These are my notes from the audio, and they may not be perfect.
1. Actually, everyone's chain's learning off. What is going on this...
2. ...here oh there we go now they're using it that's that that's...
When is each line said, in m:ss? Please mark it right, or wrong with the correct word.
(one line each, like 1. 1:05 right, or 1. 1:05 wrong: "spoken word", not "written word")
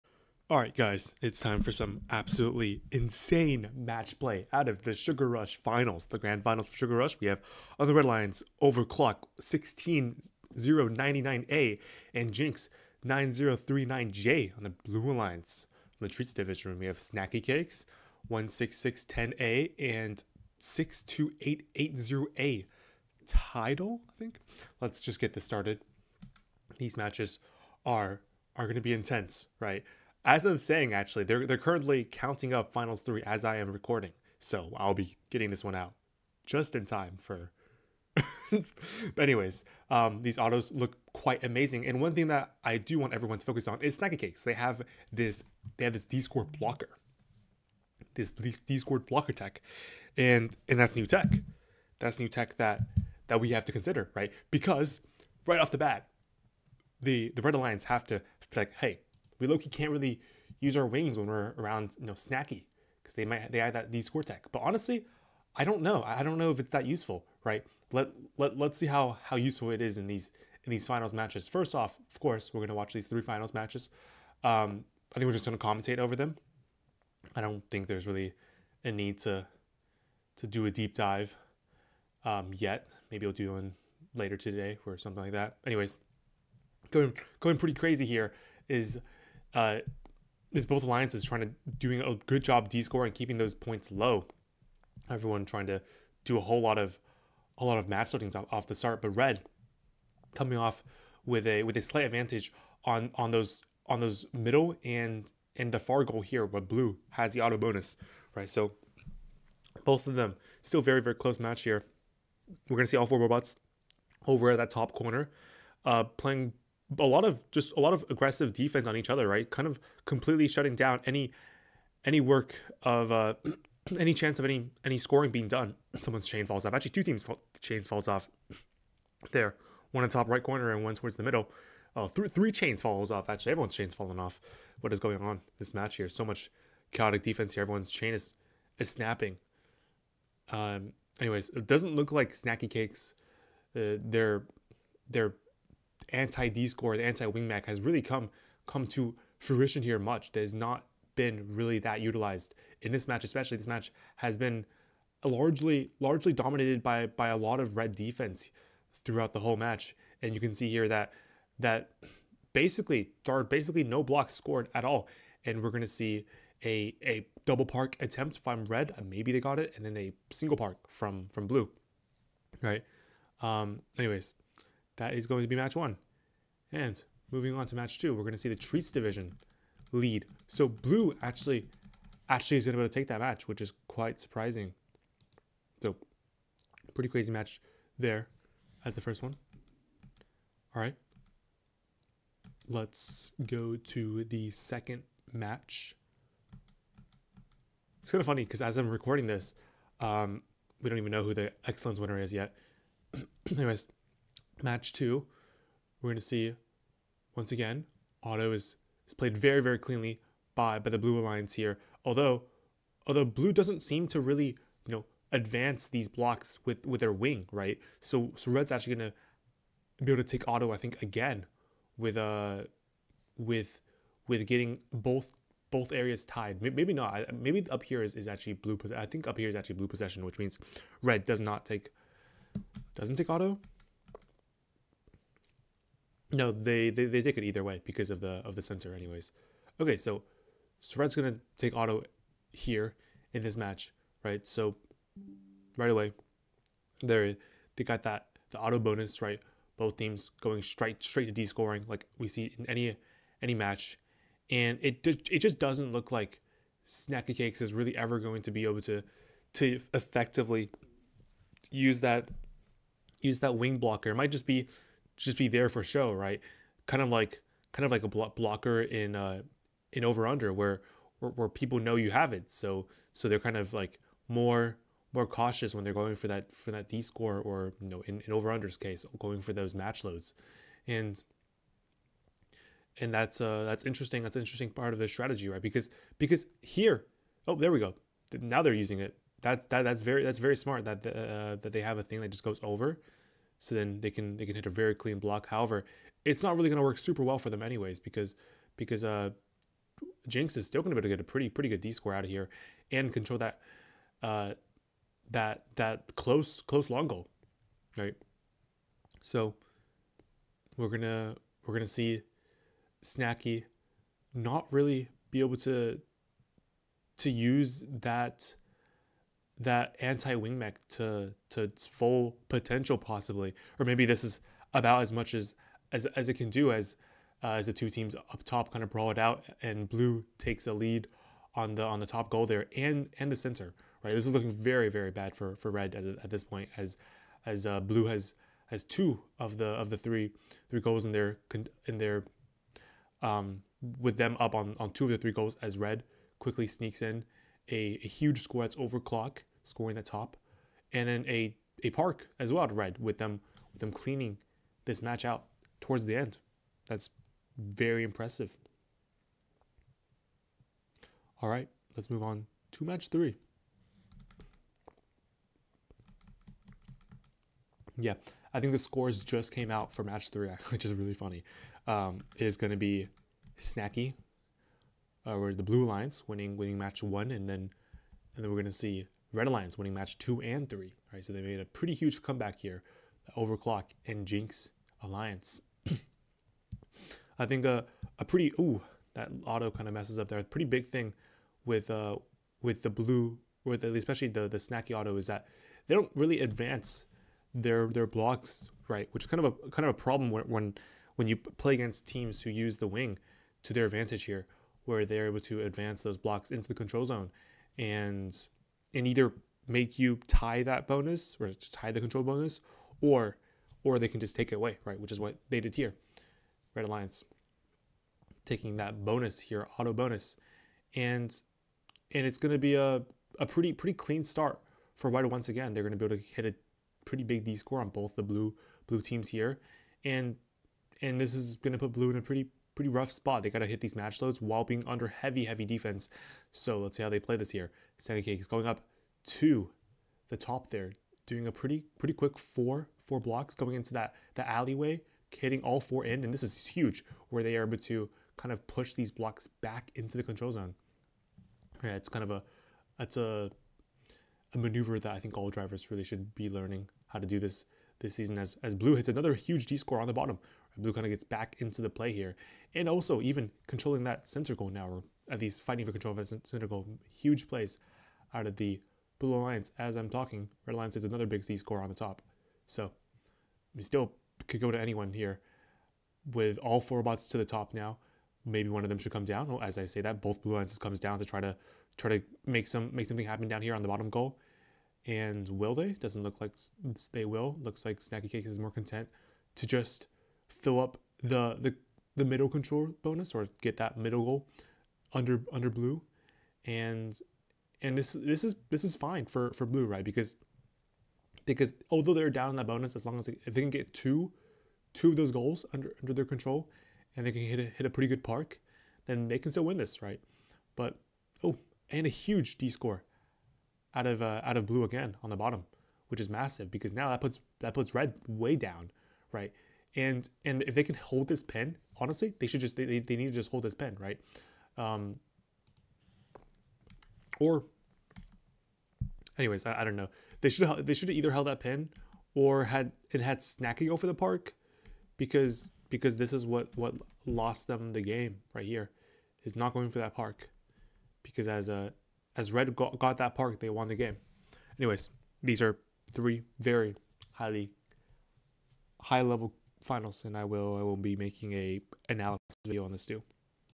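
1. 2:13 wrong: "falling", not "learning"
2. 4:46 right.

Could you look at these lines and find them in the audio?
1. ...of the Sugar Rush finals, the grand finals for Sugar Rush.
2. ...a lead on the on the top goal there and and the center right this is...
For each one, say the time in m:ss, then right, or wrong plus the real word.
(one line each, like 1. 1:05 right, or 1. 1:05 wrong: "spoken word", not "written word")
1. 0:04 right
2. 5:30 right.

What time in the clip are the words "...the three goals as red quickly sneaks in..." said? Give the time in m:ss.
5:45.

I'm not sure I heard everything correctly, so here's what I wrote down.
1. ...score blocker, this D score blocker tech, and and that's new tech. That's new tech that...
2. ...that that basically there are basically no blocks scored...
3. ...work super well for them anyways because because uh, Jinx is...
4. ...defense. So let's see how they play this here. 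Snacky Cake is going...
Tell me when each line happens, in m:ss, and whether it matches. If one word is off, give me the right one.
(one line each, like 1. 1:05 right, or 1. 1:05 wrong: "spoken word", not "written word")
1. 0:46 right
2. 2:40 right
3. 4:56 right
4. 7:15 right.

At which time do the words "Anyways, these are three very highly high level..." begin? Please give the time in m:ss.
9:04.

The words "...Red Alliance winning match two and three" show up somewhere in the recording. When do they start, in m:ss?
6:19.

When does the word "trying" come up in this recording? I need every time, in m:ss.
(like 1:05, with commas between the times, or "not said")
1:31, 1:35.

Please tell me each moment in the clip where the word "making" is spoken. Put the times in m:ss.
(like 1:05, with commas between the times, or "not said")
9:11.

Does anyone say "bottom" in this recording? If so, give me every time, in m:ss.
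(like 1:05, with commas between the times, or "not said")
7:40, 8:03, 8:35.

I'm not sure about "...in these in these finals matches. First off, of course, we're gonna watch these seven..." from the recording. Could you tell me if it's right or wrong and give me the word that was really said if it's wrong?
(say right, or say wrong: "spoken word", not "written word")
wrong: "three", not "seven".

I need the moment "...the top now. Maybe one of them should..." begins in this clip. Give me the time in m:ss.
7:57.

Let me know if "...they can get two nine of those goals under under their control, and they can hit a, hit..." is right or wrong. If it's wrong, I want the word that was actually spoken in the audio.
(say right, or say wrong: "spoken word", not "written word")
wrong: "two", not "nine".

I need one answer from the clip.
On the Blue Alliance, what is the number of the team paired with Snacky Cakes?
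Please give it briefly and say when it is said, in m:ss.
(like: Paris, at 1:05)
62880A, at 0:20.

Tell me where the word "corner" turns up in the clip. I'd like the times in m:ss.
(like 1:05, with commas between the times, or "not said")
1:54, 2:10.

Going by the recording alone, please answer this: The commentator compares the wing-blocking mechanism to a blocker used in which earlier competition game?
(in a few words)
Over Under.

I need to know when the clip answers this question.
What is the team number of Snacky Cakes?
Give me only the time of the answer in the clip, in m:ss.
0:18.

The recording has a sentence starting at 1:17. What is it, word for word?
I don't think there's really a need to to do a deep dive um, yet.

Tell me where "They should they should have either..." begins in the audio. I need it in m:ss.
8:50.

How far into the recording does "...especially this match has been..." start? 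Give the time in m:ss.
2:33.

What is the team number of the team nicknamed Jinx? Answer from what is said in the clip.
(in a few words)
9039J.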